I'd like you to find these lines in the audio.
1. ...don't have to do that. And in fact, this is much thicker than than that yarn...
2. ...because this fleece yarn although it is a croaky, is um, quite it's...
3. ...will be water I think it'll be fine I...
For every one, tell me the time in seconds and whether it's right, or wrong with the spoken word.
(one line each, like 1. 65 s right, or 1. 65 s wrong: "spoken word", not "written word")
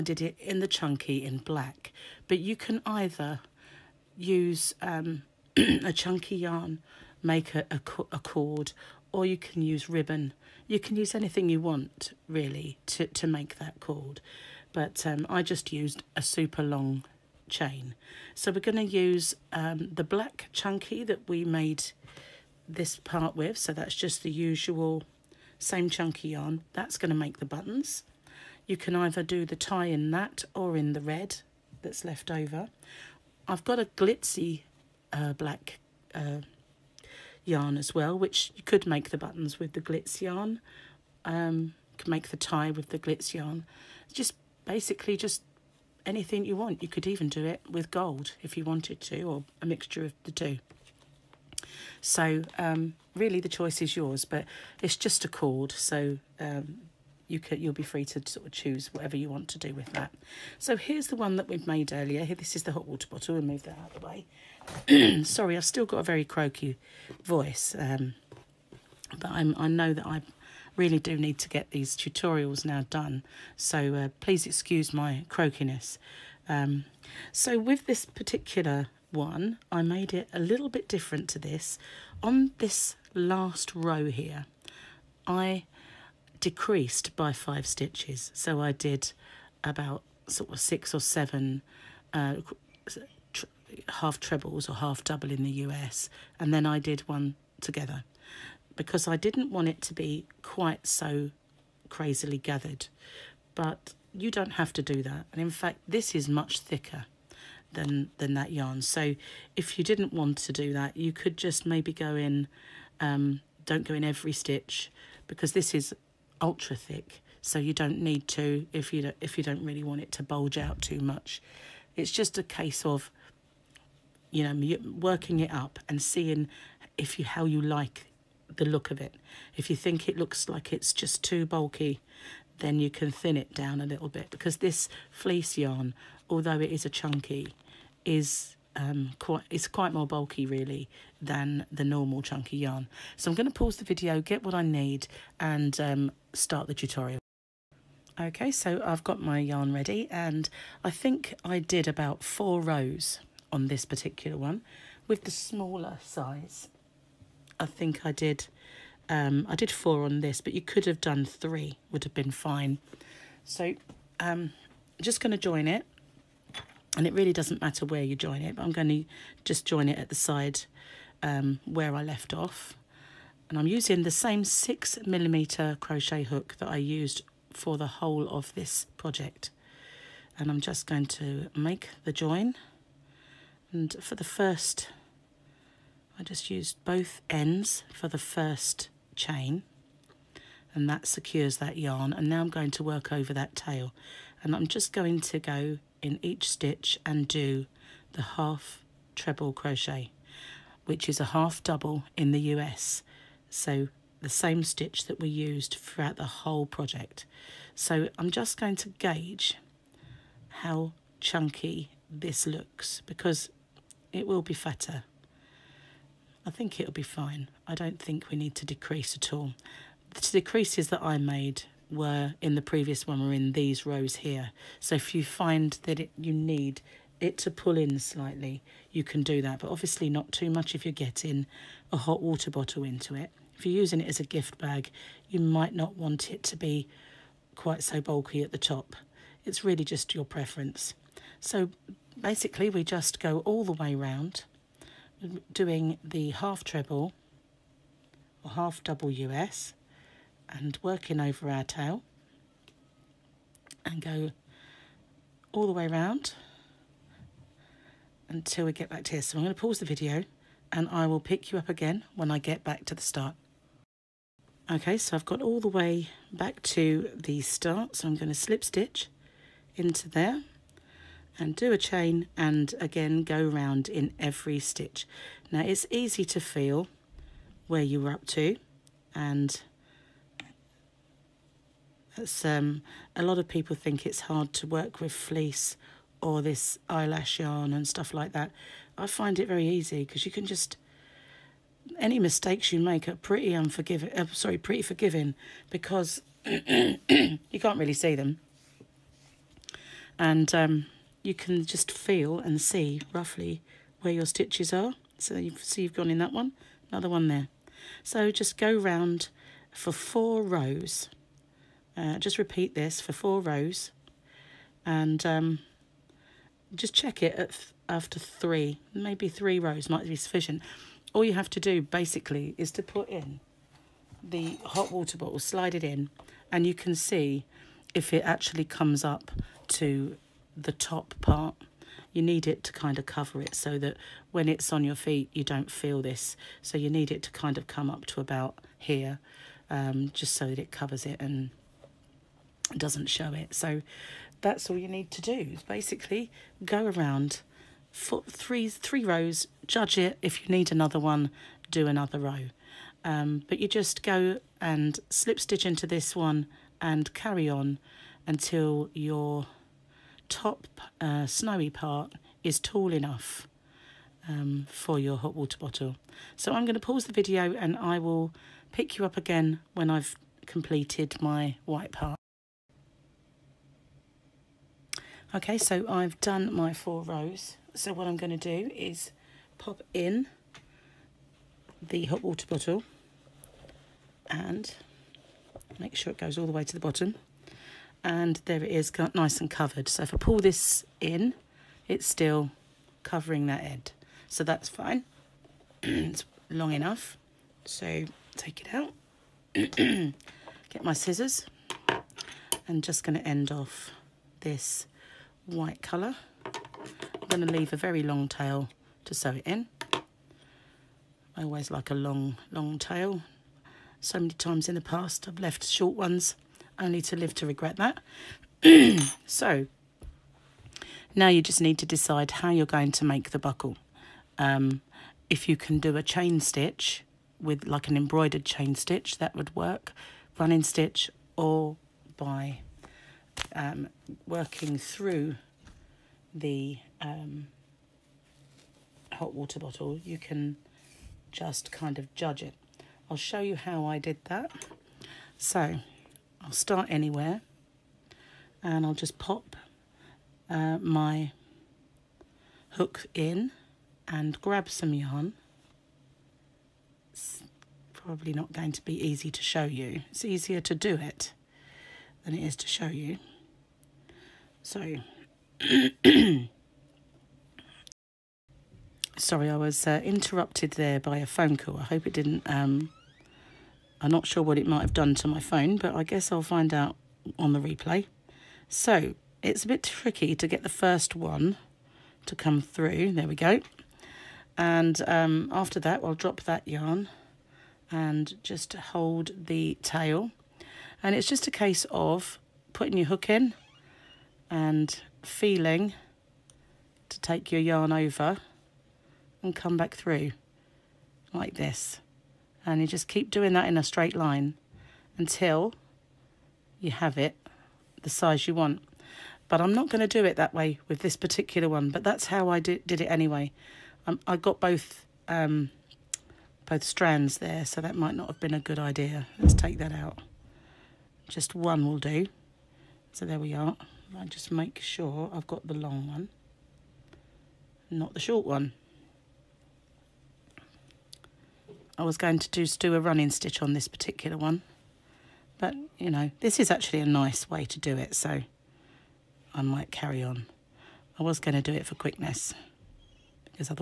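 1. 104 s right
2. 134 s wrong: "chunky", not "croaky"
3. 214 s wrong: "fatter", not "water".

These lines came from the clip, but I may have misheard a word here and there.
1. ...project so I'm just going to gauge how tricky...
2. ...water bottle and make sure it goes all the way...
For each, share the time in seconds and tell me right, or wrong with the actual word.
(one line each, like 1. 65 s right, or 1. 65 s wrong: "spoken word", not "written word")
1. 206 s wrong: "chunky", not "tricky"
2. 382 s right.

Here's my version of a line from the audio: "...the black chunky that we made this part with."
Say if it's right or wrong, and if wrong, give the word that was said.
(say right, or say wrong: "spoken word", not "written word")
right.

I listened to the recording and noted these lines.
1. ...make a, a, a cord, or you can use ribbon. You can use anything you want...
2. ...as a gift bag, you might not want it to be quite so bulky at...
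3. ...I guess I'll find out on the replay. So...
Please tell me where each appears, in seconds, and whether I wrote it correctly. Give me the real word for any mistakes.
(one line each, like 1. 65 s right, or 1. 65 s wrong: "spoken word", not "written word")
1. 7 s right
2. 234 s right
3. 475 s right.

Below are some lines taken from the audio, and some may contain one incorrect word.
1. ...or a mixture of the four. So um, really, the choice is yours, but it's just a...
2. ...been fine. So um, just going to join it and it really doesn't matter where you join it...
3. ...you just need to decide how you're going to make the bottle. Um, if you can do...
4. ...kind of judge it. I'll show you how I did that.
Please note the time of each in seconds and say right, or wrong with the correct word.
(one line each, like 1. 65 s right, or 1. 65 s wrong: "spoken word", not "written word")
1. 49 s wrong: "two", not "four"
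2. 162 s right
3. 421 s wrong: "buckle", not "bottle"
4. 441 s right.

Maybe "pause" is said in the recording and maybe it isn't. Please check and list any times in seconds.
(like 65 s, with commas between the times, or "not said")
143 s, 259 s, 366 s.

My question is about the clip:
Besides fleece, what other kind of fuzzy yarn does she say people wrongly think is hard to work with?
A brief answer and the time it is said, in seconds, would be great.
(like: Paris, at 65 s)
Eyelash yarn, at 286 s.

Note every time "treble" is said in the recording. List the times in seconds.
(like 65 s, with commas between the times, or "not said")
94 s, 199 s, 246 s.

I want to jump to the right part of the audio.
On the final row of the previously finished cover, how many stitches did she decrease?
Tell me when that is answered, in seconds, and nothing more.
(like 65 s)
87 s.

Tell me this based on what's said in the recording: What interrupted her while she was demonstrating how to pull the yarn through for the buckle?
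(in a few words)
A phone call.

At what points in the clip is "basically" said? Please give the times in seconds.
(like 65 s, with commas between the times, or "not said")
44 s, 242 s, 321 s, 345 s.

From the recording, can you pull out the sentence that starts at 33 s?
I've got a glitzy uh, black uh, yarn as well, which you could make the buttons with the glitz yarn.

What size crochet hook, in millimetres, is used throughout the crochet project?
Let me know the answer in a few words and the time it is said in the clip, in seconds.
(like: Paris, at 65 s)
6 millimetres, at 174 s.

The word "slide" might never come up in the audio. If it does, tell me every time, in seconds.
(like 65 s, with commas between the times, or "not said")
325 s.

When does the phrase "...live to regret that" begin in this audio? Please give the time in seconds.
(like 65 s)
417 s.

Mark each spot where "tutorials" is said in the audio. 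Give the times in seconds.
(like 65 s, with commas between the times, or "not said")
71 s, 146 s.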